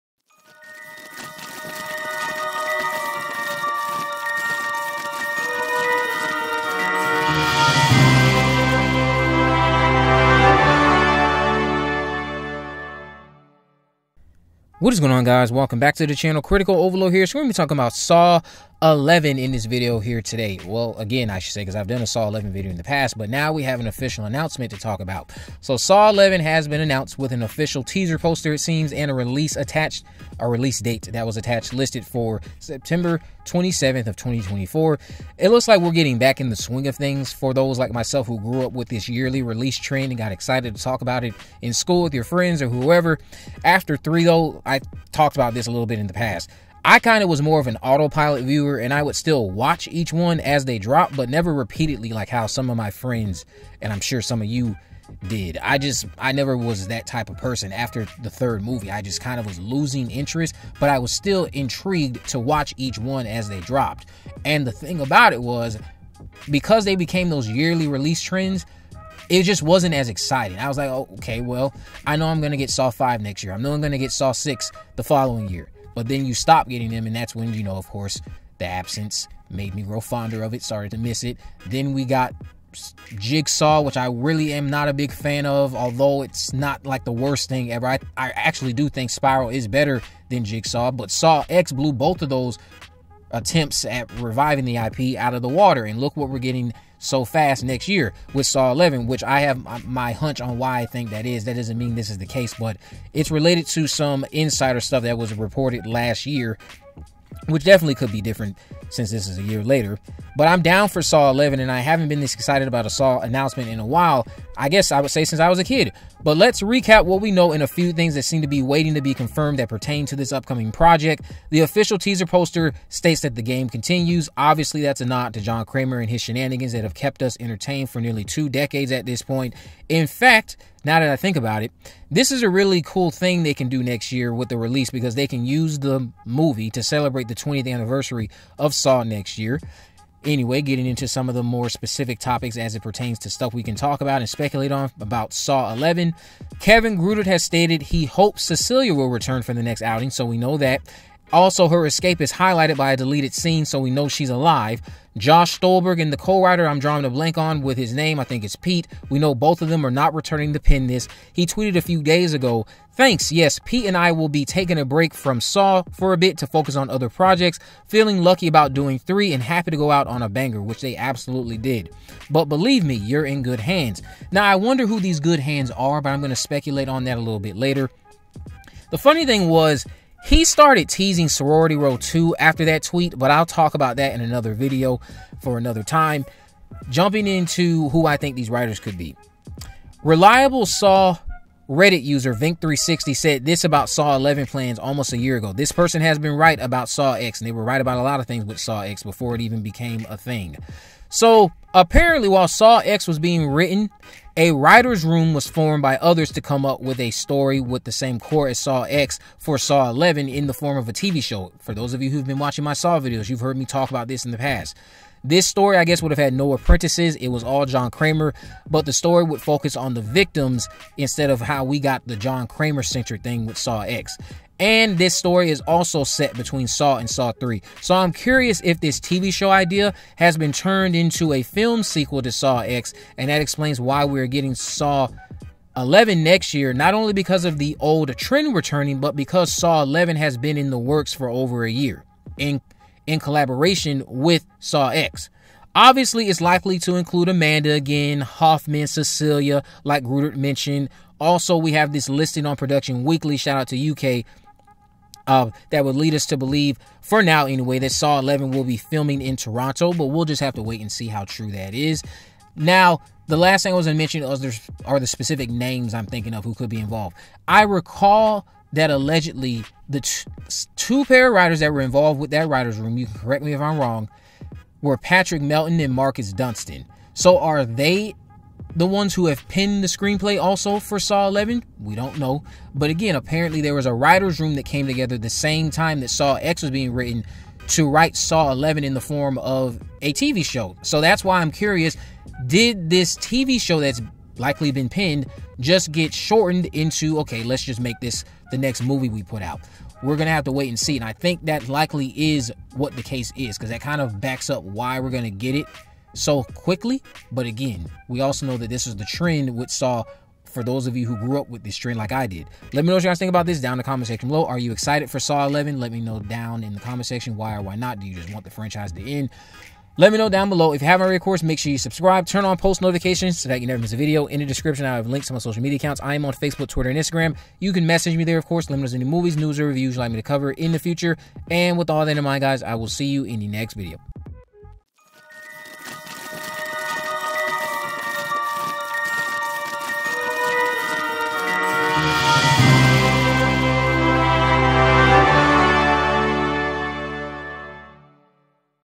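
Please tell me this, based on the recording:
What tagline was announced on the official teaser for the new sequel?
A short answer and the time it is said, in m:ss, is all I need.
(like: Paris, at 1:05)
The game continues, at 2:03.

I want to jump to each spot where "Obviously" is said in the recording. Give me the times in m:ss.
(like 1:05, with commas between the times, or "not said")
2:04, 4:05.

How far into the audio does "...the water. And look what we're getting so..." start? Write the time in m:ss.
1:35.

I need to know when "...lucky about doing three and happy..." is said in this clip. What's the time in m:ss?
2:48.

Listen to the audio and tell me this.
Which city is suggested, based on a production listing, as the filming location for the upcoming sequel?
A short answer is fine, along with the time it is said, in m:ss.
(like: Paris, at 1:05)
Toronto, at 4:19.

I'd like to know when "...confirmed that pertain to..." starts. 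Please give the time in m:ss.
1:59.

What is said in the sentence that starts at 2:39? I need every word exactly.
We know both of them are not returning the pin this.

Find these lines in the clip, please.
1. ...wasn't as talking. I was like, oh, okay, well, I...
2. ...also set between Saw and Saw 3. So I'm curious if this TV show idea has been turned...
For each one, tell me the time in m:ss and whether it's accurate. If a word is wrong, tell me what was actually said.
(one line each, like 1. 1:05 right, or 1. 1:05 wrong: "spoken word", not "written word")
1. 1:09 wrong: "exciting", not "talking"
2. 3:45 right.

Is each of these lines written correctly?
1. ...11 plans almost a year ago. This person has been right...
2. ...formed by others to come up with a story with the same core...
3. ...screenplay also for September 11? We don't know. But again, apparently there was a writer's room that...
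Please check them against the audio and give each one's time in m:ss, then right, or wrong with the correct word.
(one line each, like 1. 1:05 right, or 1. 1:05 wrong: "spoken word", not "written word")
1. 3:14 right
2. 3:25 right
3. 4:39 wrong: "Saw", not "September".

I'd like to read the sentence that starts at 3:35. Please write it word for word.
This story, I guess, would have had no apprentices.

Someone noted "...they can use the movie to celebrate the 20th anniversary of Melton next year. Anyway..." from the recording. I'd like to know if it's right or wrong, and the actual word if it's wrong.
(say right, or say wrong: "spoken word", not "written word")
wrong: "Saw", not "Melton".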